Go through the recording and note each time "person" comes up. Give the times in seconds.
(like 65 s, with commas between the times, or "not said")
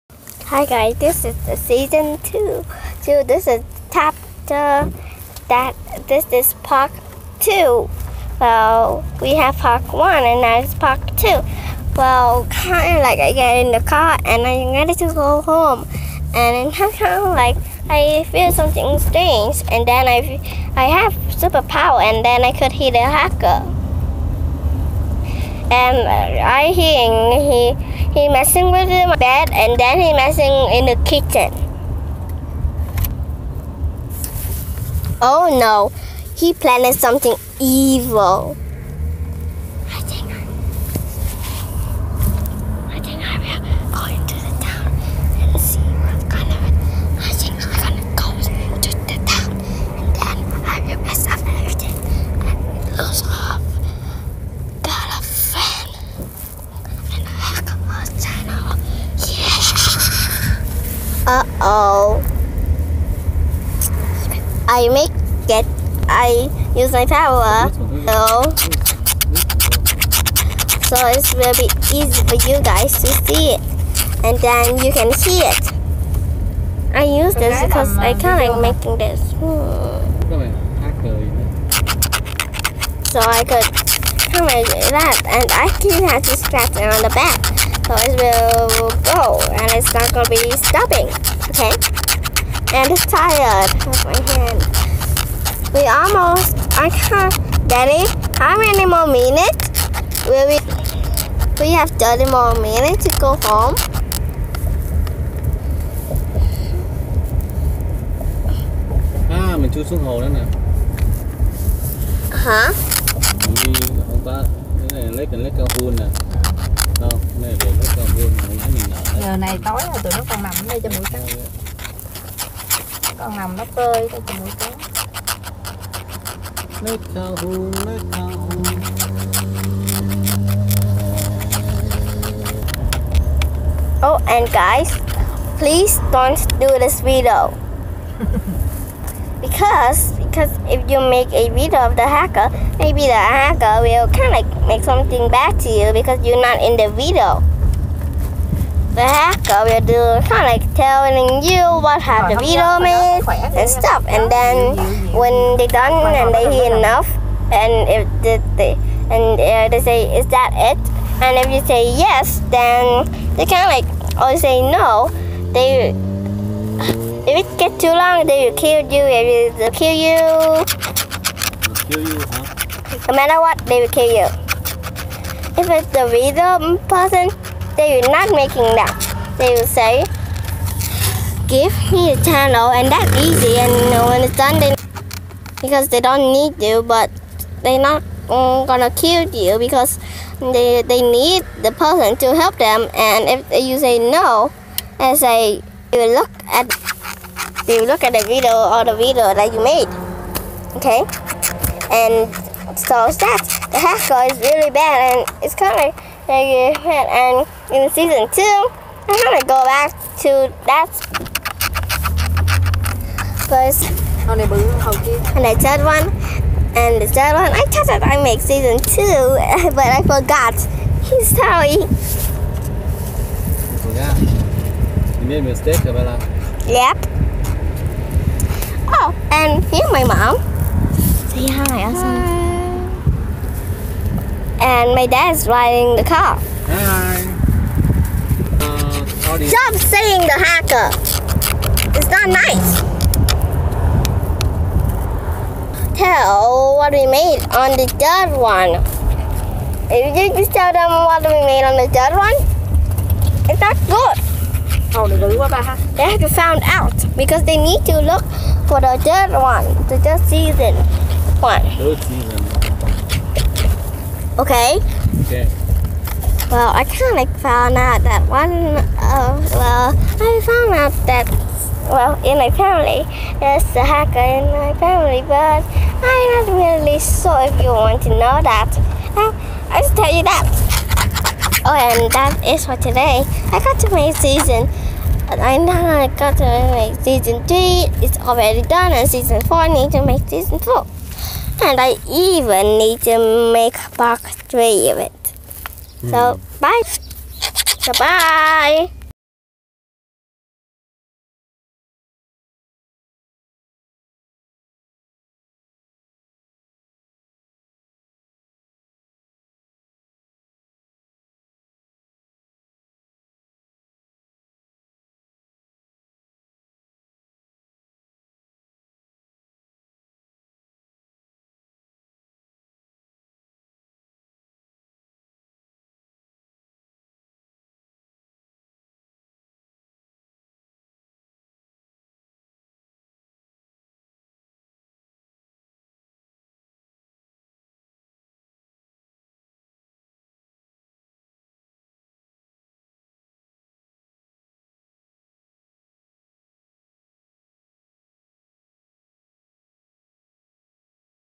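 176 s, 191 s.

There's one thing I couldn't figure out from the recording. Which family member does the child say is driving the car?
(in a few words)
Dad.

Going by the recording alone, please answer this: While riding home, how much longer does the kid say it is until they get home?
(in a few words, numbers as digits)
30 minutes.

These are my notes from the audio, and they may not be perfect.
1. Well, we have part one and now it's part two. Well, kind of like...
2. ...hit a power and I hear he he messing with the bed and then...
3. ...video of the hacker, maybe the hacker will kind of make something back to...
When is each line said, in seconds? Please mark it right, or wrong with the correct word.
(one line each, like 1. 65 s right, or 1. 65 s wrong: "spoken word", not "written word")
1. 8 s right
2. 22 s wrong: "hacker", not "power"
3. 141 s right.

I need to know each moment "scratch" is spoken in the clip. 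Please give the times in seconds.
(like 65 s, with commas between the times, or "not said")
86 s.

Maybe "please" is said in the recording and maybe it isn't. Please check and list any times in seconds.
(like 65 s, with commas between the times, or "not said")
135 s.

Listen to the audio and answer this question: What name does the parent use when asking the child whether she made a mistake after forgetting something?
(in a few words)
Abella.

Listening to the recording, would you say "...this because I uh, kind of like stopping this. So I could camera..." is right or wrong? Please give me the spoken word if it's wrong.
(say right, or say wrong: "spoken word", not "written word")
wrong: "making", not "stopping".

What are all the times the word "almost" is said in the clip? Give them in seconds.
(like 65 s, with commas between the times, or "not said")
95 s.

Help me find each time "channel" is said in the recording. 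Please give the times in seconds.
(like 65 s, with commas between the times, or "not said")
182 s.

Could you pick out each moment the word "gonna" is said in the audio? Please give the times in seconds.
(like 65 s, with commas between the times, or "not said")
90 s, 188 s.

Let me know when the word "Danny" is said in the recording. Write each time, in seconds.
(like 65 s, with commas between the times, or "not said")
97 s.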